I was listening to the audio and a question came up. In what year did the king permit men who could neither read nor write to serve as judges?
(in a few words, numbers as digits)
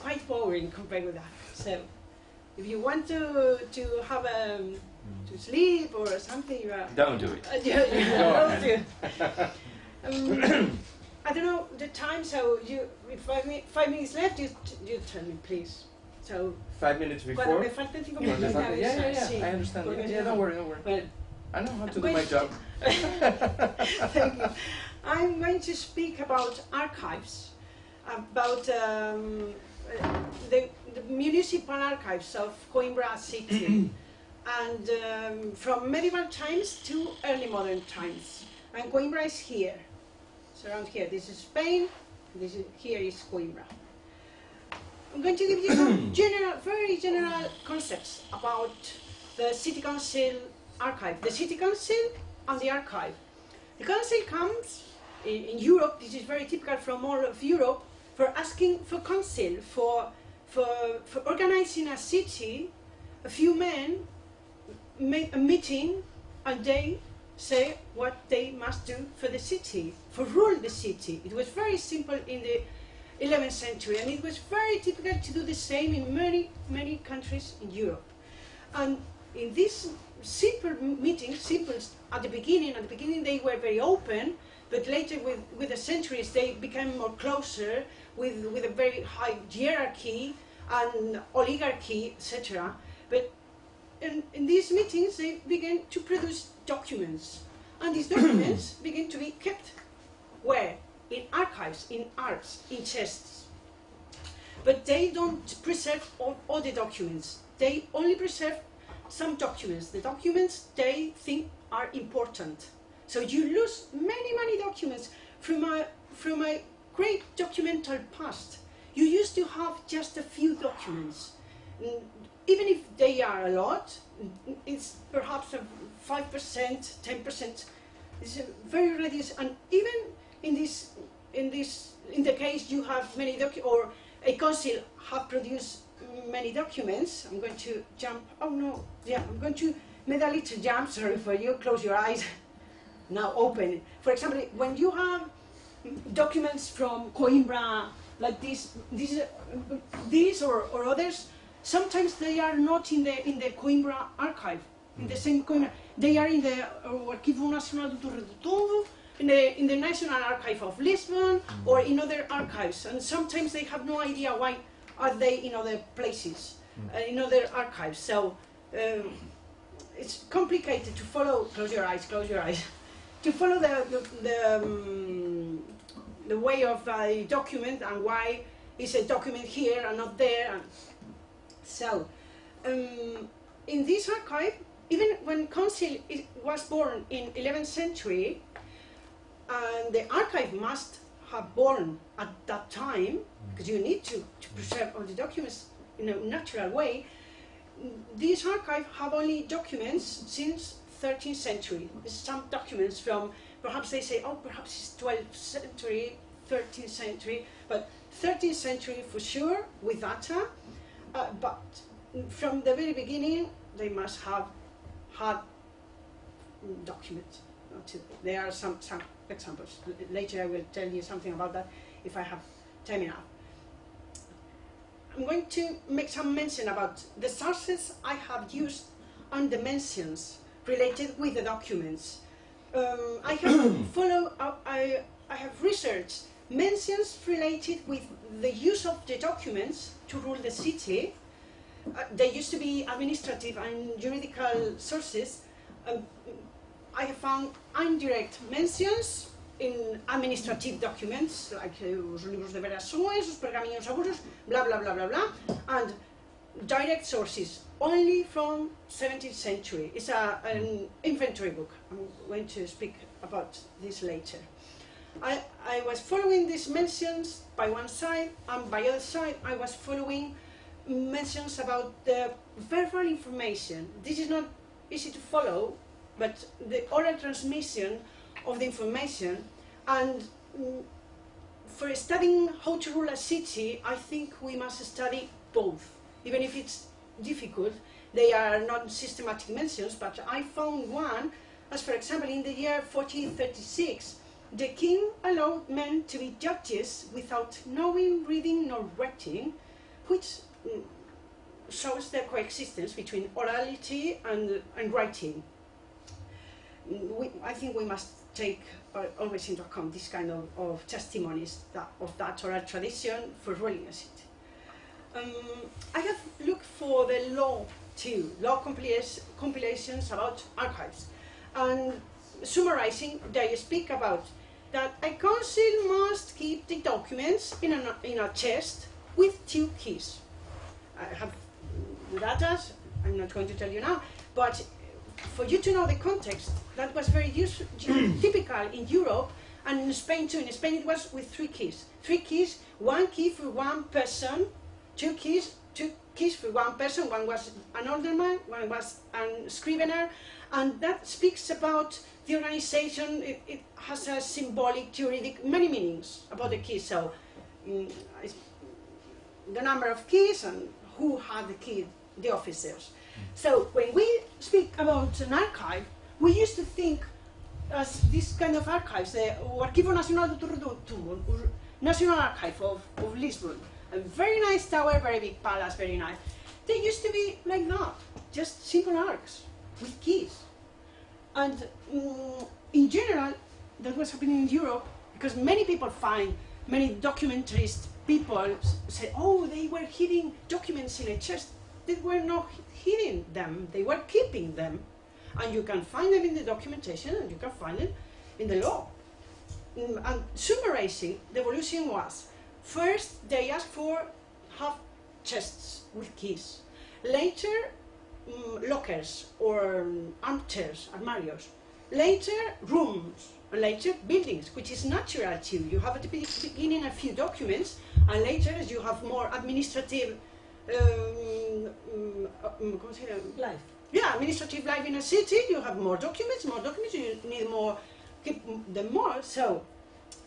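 1436.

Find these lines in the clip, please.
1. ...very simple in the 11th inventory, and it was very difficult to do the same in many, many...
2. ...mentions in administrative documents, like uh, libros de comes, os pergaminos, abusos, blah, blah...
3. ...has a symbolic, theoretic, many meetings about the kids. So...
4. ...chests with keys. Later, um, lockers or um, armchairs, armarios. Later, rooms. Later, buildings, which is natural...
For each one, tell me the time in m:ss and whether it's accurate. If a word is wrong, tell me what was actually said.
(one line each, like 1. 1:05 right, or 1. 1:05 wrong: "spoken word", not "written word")
1. 1:11 wrong: "century", not "inventory"
2. 4:08 wrong: "verações", not "comes"
3. 5:53 wrong: "meanings", not "meetings"
4. 6:45 right.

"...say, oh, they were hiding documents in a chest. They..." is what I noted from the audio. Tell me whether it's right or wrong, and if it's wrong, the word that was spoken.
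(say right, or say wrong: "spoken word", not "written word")
right.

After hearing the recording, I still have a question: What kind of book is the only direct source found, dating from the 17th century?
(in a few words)
Inventory book.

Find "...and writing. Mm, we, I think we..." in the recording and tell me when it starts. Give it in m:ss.
5:04.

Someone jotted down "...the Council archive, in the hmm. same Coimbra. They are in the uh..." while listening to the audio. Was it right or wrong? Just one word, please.
wrong.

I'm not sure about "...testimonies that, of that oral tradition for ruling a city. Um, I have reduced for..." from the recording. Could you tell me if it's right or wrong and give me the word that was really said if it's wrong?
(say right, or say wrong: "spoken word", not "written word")
wrong: "looked", not "reduced".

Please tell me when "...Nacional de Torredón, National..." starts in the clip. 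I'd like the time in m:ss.
6:09.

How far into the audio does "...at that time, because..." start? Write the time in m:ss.
3:12.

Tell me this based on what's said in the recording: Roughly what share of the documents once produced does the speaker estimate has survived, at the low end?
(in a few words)
5%.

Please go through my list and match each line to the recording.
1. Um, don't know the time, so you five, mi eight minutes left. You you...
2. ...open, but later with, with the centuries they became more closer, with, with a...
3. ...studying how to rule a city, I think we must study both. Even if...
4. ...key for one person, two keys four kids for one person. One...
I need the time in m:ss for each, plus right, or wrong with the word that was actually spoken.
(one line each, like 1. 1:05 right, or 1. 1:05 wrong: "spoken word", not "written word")
1. 0:10 wrong: "five", not "eight"
2. 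1:23 right
3. 4:41 right
4. 5:43 wrong: "two", not "four".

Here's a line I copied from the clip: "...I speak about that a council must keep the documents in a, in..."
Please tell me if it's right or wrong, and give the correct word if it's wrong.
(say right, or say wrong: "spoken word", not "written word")
right.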